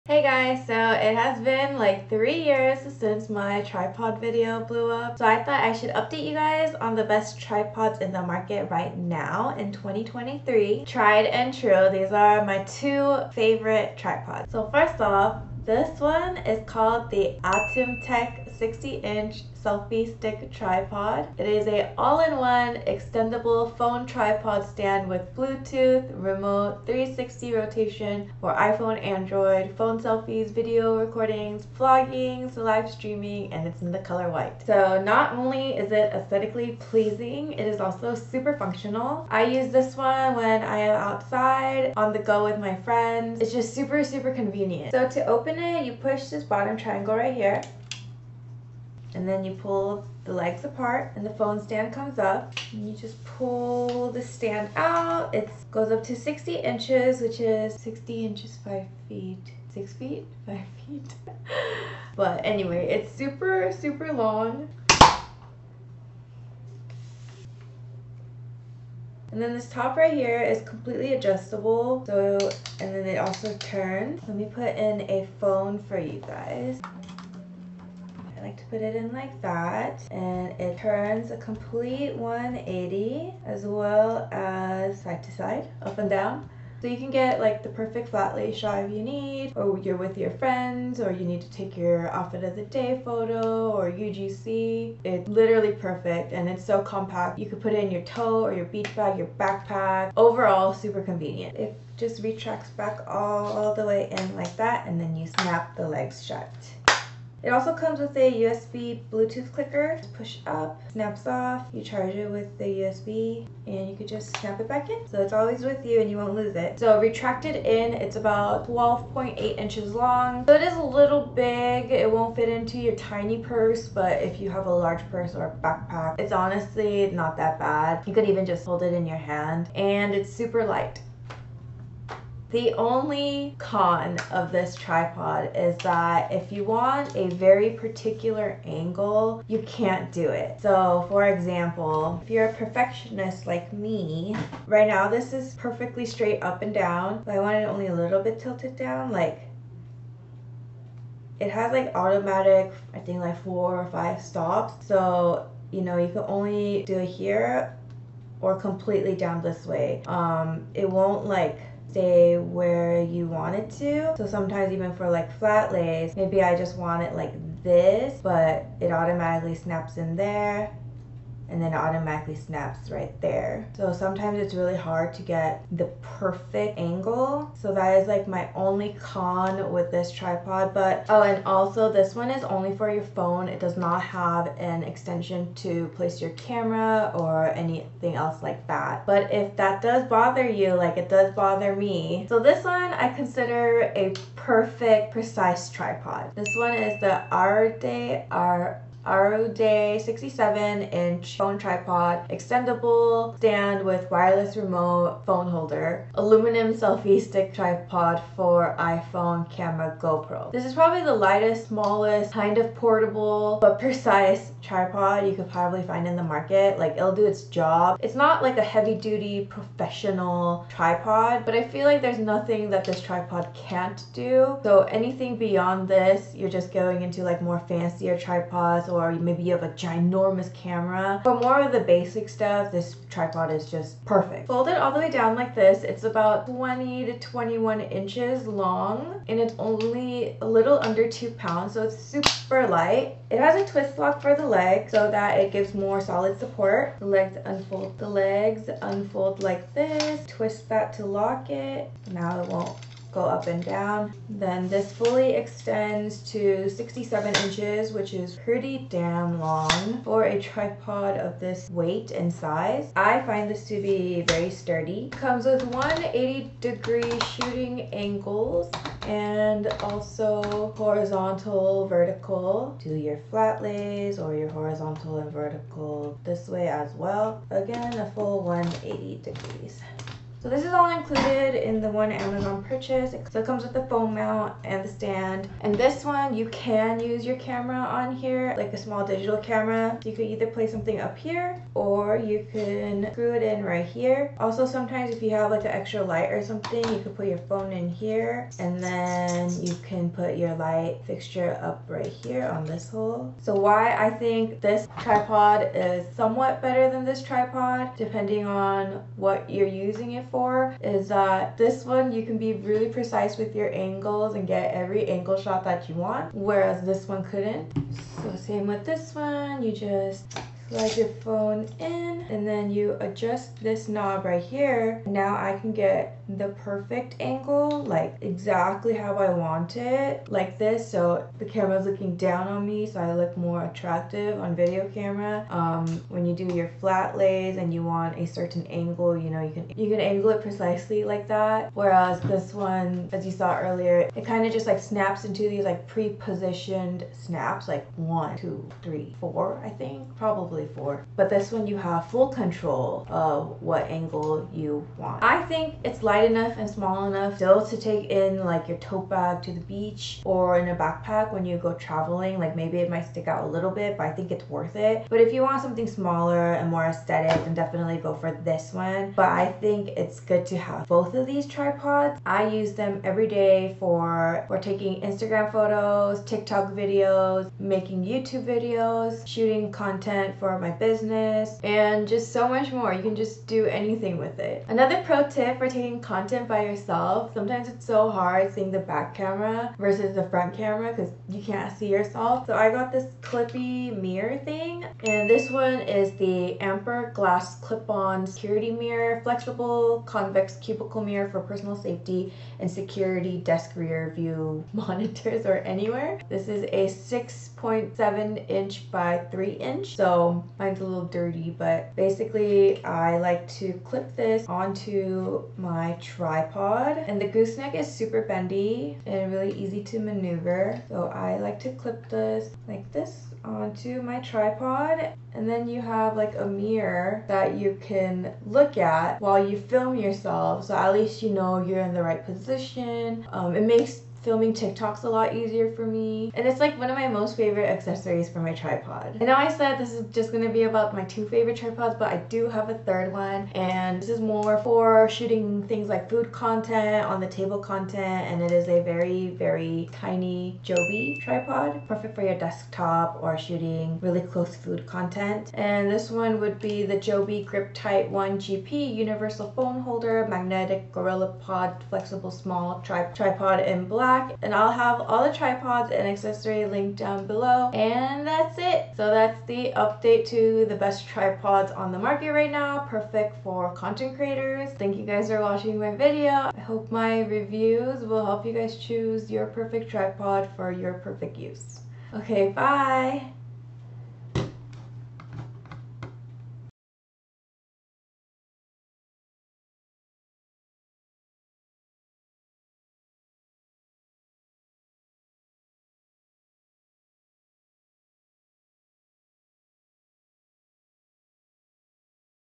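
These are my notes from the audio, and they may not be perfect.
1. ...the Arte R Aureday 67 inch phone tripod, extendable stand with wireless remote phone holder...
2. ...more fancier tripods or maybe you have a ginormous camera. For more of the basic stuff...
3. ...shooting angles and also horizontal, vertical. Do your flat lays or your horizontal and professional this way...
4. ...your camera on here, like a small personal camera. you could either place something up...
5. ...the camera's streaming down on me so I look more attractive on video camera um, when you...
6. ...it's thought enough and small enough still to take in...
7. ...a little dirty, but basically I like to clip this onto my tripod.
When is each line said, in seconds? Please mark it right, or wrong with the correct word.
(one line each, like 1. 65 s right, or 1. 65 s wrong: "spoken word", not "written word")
1. 197 s right
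2. 227 s right
3. 267 s wrong: "vertical", not "professional"
4. 287 s wrong: "digital", not "personal"
5. 331 s wrong: "looking", not "streaming"
6. 355 s wrong: "light", not "thought"
7. 410 s right.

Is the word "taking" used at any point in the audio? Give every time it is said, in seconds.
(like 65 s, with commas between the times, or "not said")
374 s, 385 s.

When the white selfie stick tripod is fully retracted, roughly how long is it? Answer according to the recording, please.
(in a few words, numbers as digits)
12.8 inches.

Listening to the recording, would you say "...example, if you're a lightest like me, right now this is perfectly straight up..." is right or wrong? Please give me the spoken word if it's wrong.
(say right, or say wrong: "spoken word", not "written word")
wrong: "perfectionist", not "lightest".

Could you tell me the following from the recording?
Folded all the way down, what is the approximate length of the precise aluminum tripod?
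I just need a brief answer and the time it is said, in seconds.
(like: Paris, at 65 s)
20 to 21 inches, at 236 s.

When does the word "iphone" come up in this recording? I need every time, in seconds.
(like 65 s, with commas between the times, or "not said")
28 s, 208 s.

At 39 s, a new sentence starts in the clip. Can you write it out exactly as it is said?
I use this one when I am outside, on the go with my friends.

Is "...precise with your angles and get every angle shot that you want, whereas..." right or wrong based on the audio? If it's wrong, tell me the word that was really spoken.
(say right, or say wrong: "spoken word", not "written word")
right.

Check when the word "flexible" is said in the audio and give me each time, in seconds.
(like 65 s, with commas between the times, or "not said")
399 s, 461 s.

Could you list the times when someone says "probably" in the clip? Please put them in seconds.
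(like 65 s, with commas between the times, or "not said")
210 s, 215 s, 350 s.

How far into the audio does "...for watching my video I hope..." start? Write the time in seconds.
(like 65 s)
475 s.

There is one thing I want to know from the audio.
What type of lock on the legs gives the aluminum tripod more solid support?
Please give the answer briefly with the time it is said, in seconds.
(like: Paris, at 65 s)
twist lock, at 243 s.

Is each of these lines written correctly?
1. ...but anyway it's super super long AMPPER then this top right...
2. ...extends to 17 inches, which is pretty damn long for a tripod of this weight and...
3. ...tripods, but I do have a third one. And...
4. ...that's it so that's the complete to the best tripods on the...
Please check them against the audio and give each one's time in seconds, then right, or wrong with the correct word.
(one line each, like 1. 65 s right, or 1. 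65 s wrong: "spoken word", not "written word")
1. 62 s wrong: "And", not "AMPPER"
2. 255 s wrong: "67", not "17"
3. 441 s right
4. 468 s wrong: "update", not "complete".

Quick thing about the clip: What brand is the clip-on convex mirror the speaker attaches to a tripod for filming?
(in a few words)
AMPPER.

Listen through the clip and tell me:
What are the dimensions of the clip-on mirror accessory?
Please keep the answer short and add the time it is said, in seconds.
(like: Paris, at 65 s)
6.7 by 3 inches, at 406 s.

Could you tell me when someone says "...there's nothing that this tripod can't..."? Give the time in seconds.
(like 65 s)
222 s.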